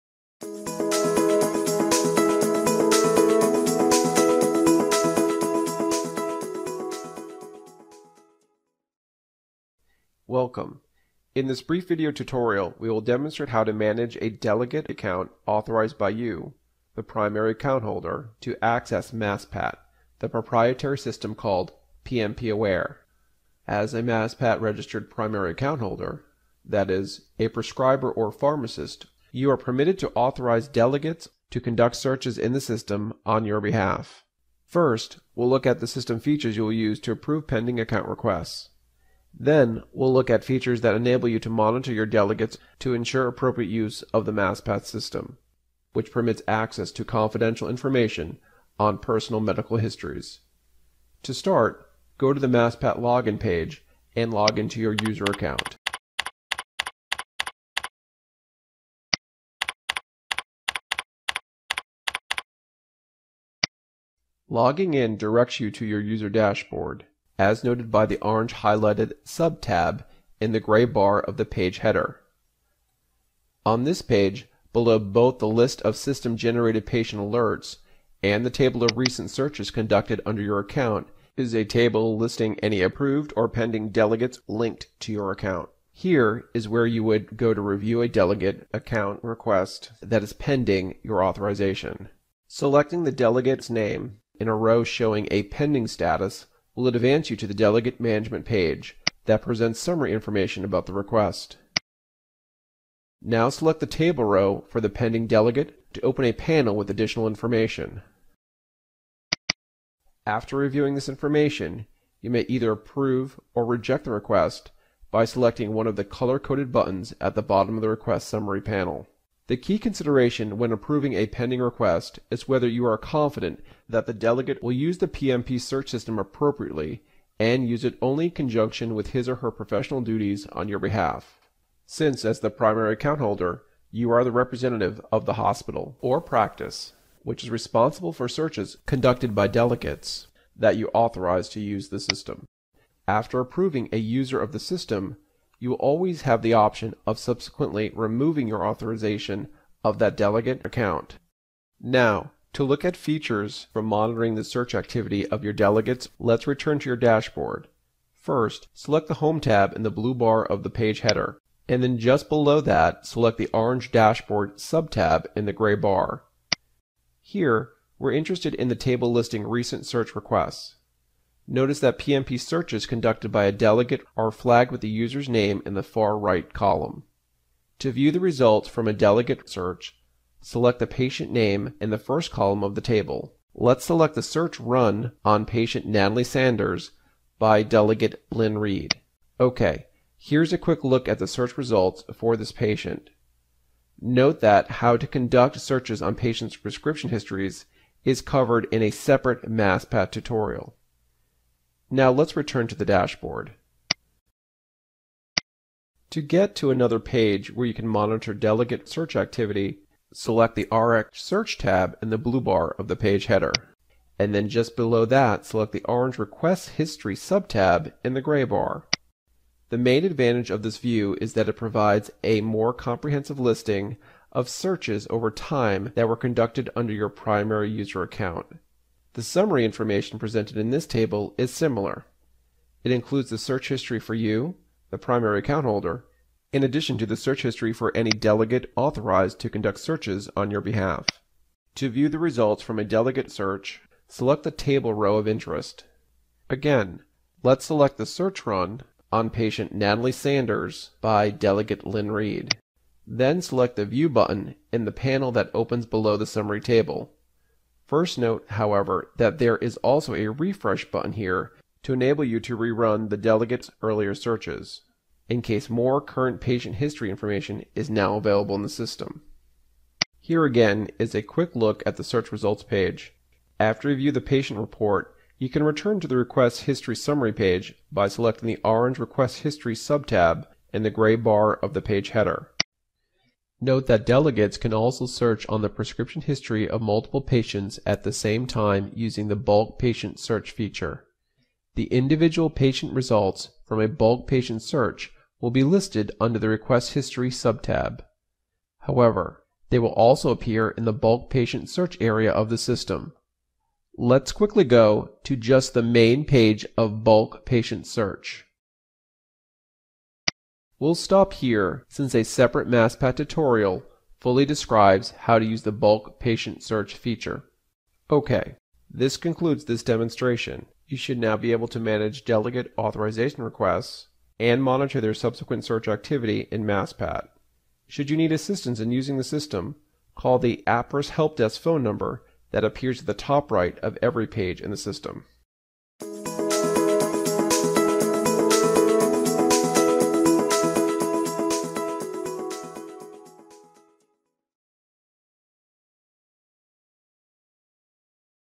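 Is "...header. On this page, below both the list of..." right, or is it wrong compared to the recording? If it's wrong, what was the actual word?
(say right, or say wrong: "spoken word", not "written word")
right.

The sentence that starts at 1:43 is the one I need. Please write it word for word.
Now select the table row for the pending delegate to open a panel with additional information.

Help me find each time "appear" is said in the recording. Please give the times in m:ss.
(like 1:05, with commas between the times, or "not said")
5:00, 5:32.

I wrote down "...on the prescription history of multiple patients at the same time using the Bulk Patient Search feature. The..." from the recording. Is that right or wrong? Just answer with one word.
right.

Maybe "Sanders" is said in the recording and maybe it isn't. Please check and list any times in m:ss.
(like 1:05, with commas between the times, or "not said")
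3:06, 4:10.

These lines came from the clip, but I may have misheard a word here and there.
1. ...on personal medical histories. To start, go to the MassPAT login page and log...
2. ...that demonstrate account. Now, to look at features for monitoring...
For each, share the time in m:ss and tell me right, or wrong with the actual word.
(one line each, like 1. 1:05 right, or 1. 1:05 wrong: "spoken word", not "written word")
1. 0:48 right
2. 2:29 wrong: "delegate", not "demonstrate".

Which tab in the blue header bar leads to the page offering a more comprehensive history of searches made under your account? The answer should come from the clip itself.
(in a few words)
RX Search.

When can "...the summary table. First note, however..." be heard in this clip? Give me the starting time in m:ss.
4:16.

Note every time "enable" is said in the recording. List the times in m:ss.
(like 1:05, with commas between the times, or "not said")
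0:40, 4:21.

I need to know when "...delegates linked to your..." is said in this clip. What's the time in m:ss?
1:23.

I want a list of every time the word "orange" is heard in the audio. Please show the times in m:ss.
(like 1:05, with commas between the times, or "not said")
1:08, 2:43, 3:35, 4:38.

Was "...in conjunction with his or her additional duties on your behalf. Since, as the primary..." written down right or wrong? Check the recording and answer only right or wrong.
wrong.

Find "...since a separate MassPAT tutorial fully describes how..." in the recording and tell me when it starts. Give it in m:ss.
5:11.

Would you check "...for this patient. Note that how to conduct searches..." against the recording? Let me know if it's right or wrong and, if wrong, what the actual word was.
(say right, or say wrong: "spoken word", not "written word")
right.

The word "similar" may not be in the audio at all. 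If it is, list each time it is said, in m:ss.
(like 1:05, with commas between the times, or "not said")
3:51.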